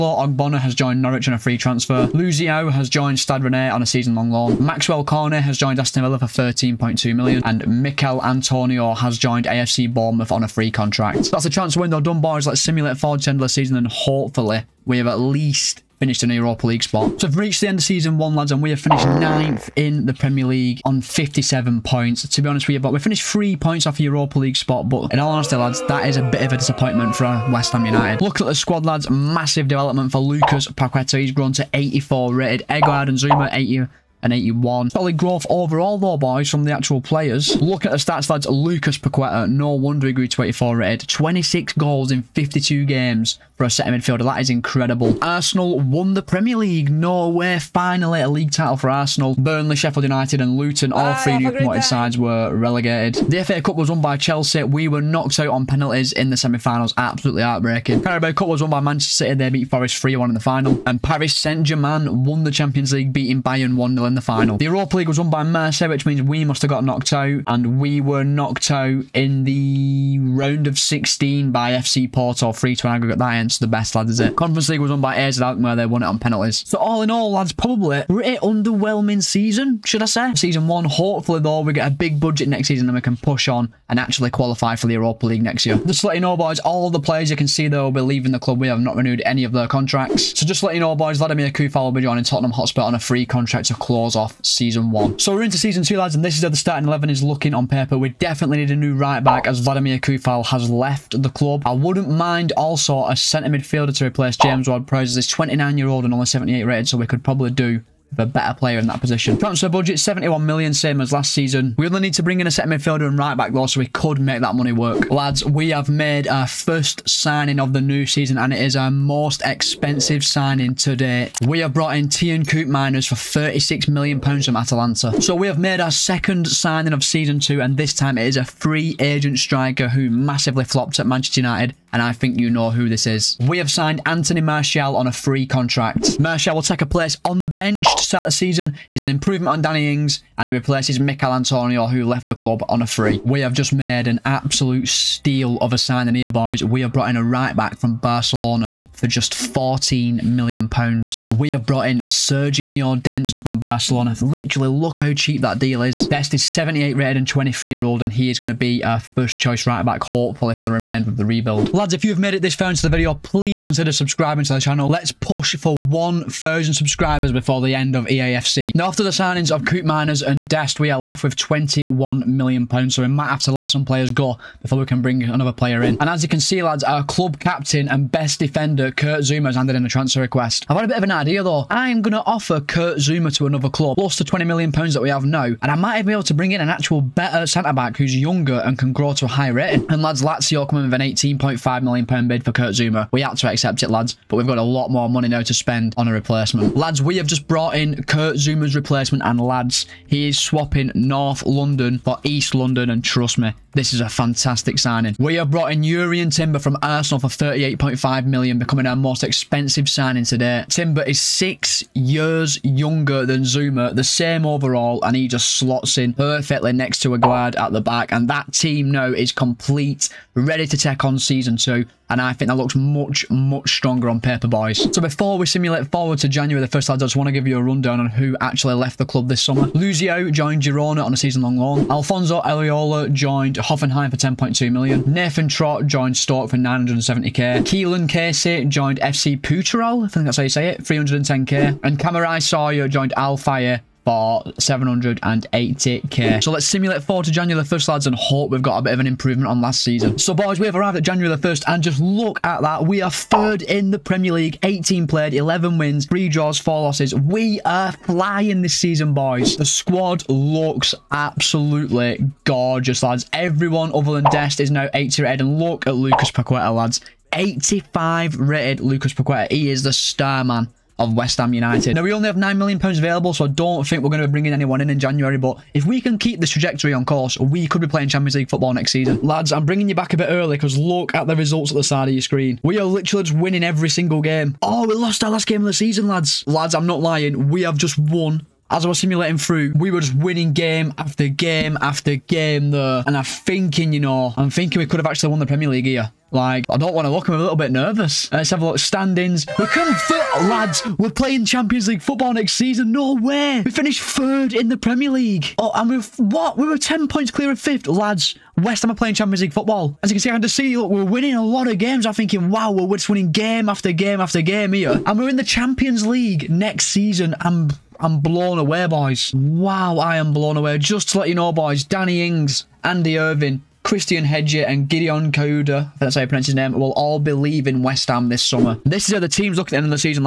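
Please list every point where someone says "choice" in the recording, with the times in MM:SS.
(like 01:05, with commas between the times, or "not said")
02:39.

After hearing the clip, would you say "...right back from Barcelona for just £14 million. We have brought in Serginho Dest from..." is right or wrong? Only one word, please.
right.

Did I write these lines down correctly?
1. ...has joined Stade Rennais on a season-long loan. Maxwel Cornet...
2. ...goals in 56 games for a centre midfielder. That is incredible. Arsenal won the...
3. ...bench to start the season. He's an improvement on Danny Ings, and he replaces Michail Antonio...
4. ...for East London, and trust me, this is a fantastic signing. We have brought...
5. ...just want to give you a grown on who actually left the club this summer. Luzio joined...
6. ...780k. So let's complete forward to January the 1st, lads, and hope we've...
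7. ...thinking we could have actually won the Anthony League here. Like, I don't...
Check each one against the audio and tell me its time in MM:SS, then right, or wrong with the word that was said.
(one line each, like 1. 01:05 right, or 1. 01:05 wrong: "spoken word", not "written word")
1. 00:02 right
2. 00:41 wrong: "52", not "56"
3. 02:17 right
4. 03:21 right
5. 03:46 wrong: "rundown", not "grown"
6. 04:04 wrong: "simulate", not "complete"
7. 04:54 wrong: "Premier", not "Anthony".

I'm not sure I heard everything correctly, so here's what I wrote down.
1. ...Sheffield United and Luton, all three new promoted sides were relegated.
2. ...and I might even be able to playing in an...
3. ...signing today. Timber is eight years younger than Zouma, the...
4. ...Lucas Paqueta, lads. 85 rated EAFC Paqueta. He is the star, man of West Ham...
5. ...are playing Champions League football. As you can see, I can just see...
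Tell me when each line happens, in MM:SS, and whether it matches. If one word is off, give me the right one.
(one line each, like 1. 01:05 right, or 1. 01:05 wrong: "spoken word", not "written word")
1. 00:49 right
2. 03:05 wrong: "bring", not "playing"
3. 03:29 wrong: "six", not "eight"
4. 04:25 wrong: "Lucas", not "EAFC"
5. 05:08 right.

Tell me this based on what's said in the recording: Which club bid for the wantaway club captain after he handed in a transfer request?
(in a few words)
Lazio.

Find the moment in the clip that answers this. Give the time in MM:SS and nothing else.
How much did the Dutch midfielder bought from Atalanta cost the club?
02:03.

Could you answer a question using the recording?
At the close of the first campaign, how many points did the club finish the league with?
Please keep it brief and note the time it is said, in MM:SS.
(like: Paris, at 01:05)
57, at 00:21.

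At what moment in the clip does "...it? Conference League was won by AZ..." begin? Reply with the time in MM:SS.
01:14.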